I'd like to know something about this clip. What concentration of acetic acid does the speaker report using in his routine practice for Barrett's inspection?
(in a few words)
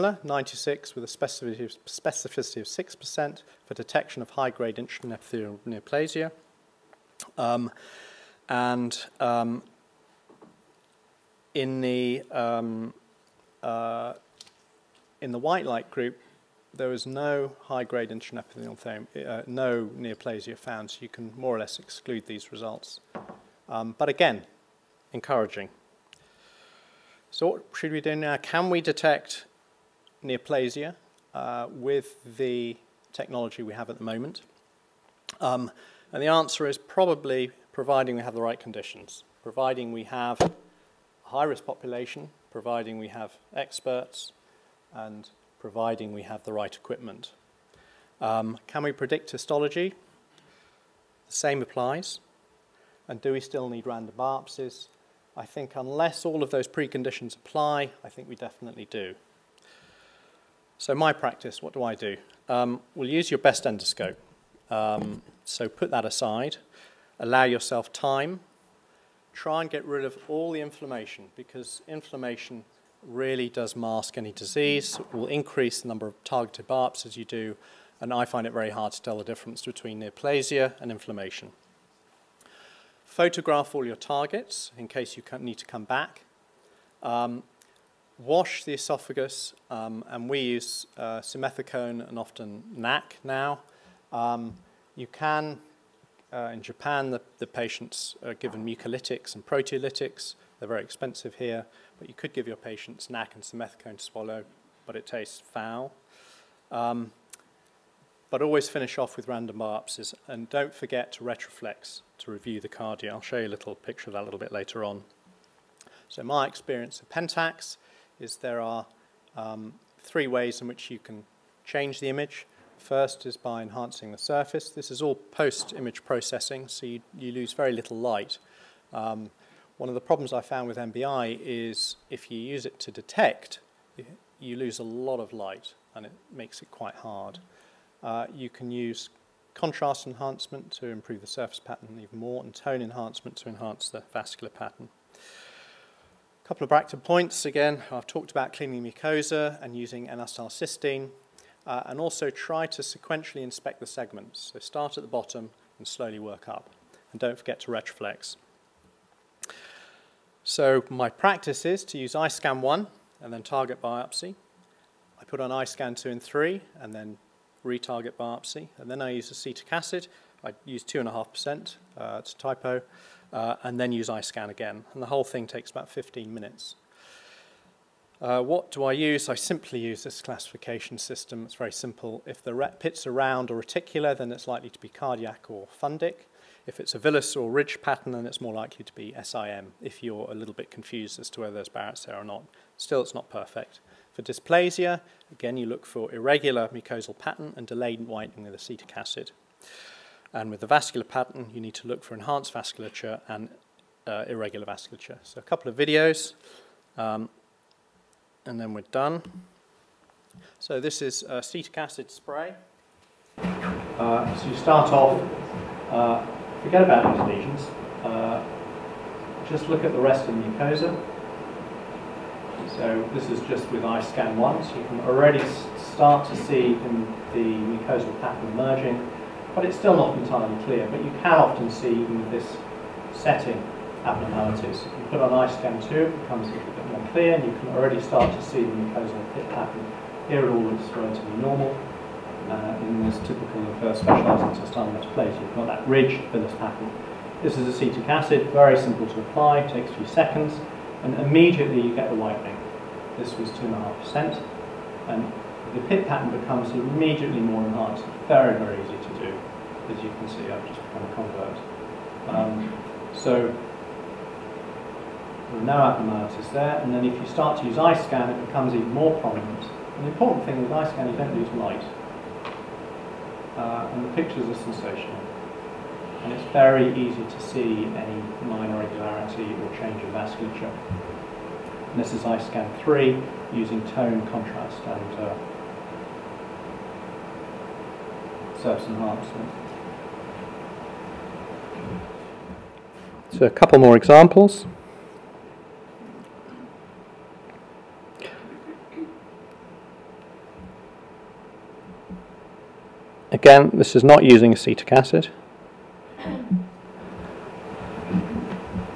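2.5%.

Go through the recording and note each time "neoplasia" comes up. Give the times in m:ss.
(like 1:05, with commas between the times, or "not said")
0:05, 0:19, 0:30, 1:20.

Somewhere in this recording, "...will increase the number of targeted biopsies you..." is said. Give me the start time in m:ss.
1:15.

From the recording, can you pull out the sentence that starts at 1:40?
They're very expensive here, but you could give your patients NAC and simethicone to swallow, but it tastes foul.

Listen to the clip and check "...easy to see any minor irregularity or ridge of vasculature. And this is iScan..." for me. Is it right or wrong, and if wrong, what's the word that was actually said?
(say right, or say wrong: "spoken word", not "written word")
wrong: "change", not "ridge".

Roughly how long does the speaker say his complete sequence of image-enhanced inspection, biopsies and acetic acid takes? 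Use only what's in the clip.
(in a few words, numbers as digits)
15 minutes.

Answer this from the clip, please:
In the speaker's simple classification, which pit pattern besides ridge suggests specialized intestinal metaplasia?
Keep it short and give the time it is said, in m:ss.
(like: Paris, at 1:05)
villus, at 3:06.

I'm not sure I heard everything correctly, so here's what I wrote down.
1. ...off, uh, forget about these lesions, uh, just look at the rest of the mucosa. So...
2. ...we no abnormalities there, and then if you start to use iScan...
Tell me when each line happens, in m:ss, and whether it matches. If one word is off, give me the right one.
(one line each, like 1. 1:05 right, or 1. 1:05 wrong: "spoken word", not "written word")
1. 3:34 right
2. 4:25 right.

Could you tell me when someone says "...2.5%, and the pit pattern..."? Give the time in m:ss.
4:13.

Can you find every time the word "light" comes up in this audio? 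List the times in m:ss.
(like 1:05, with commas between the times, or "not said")
0:15, 2:07, 2:15, 4:31.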